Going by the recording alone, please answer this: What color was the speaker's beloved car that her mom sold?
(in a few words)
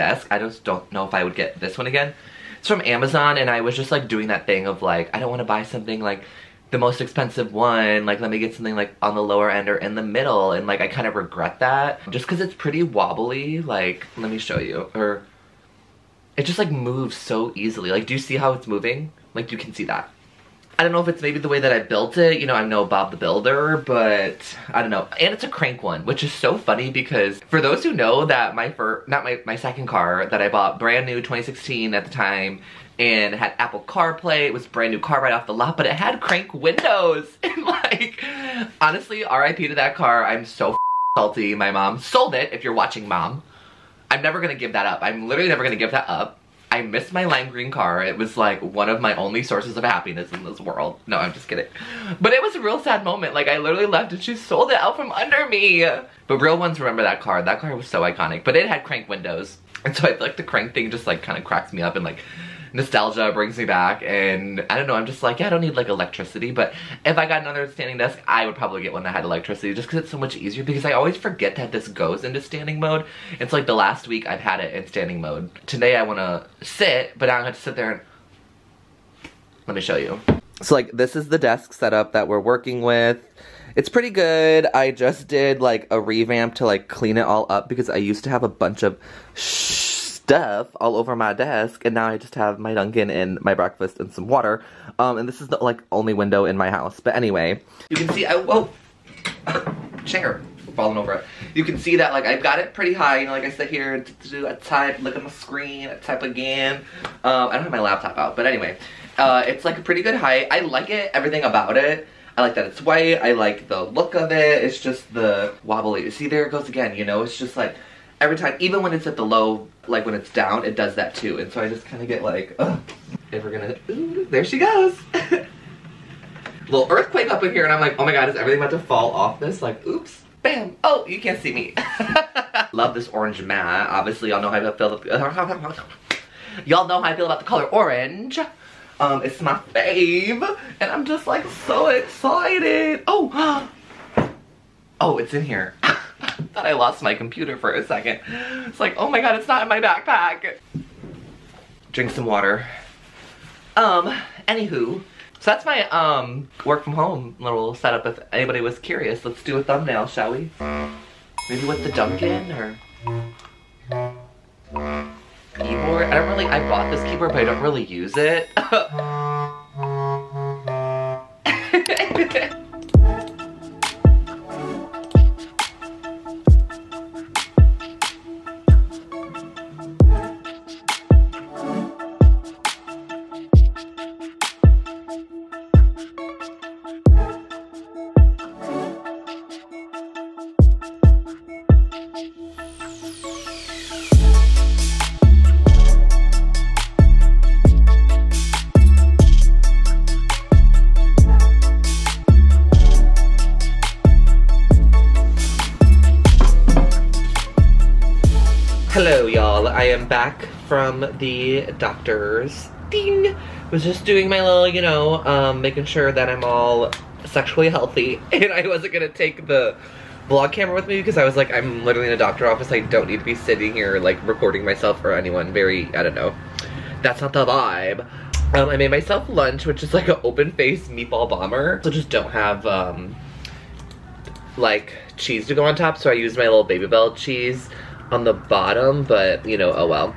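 lime green.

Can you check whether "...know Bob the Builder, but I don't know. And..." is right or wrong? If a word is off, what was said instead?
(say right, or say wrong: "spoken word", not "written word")
right.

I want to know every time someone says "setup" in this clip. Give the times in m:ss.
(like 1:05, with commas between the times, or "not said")
1:21, 2:37.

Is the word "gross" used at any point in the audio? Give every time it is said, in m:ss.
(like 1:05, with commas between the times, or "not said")
not said.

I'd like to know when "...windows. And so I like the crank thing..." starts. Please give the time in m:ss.
0:59.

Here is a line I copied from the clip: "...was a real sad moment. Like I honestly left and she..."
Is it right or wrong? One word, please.
wrong.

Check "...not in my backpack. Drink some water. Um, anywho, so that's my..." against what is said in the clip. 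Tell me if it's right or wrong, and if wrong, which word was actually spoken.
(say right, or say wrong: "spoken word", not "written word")
right.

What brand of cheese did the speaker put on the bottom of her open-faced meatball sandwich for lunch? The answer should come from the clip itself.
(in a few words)
Babybel.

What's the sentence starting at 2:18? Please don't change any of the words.
Um, it's my fave, and I'm just like so excited.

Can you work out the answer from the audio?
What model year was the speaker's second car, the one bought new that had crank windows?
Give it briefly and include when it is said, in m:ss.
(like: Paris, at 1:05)
2016, at 0:31.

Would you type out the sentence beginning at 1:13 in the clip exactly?
It's like the last week I've had it in standing mode.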